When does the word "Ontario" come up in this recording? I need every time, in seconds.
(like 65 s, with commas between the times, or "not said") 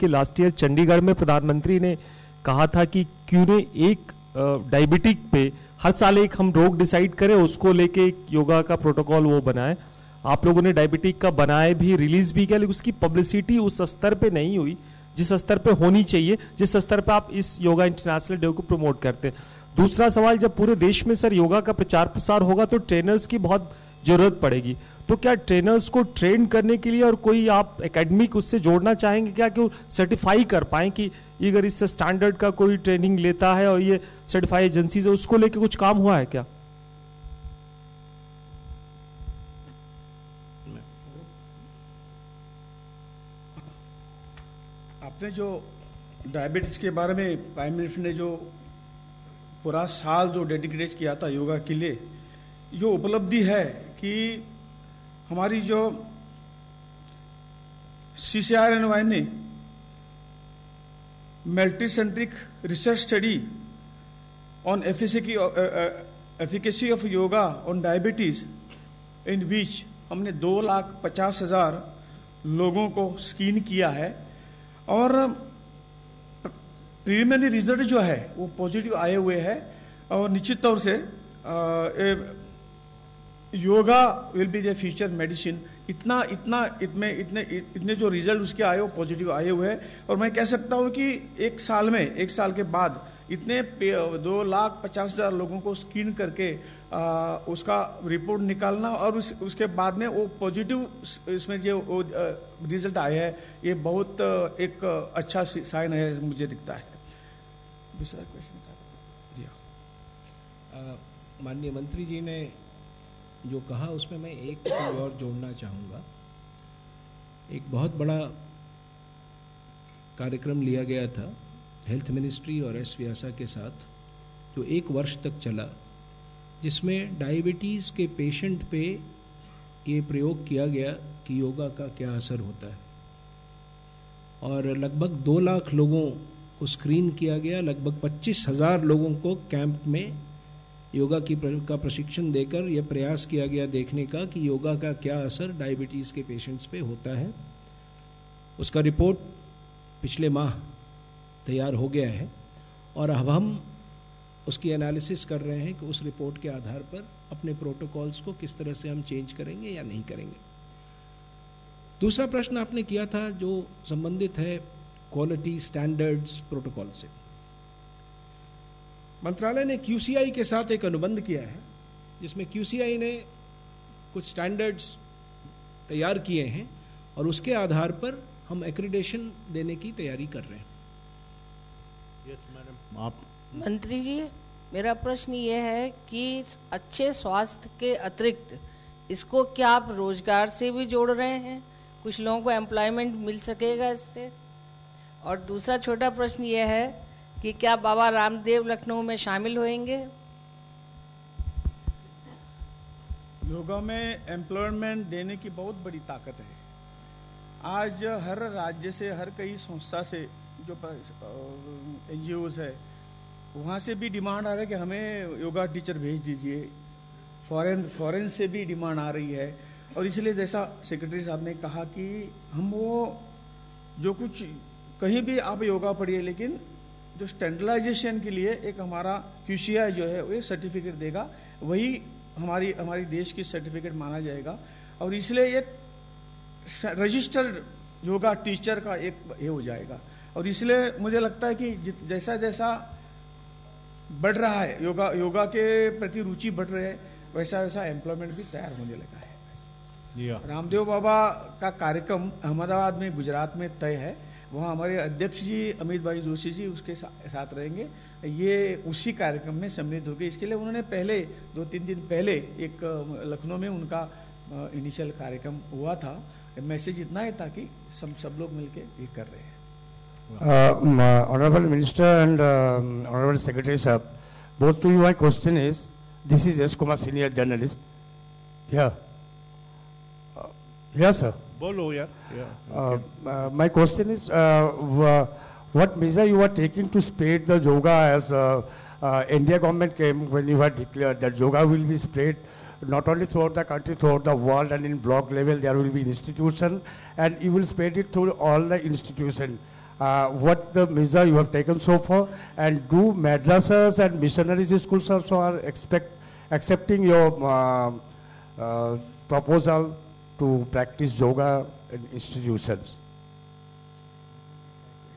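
not said.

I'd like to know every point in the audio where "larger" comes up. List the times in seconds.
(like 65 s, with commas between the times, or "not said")
not said.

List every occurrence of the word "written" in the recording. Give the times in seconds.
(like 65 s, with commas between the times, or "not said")
not said.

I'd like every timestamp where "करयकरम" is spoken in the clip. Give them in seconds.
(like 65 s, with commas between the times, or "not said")
120 s, 251 s, 259 s, 265 s.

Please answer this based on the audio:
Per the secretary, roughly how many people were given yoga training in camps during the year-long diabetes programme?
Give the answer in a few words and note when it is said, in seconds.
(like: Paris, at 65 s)
25000, at 138 s.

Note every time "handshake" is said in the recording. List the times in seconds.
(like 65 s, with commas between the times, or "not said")
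not said.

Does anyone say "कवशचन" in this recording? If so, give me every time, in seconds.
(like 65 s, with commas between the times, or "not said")
108 s, 275 s.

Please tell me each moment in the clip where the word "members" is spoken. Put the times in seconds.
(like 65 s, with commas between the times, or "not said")
not said.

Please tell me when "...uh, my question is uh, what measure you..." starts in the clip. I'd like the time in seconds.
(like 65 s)
282 s.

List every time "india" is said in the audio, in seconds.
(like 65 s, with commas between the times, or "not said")
289 s.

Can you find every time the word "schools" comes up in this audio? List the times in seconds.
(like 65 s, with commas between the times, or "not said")
304 s.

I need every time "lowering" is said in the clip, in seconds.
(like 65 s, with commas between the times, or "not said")
not said.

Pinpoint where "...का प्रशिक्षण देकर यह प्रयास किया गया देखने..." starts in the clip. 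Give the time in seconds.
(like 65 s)
141 s.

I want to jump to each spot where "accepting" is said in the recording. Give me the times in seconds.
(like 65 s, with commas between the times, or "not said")
306 s.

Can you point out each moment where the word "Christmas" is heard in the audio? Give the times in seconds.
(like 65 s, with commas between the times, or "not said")
not said.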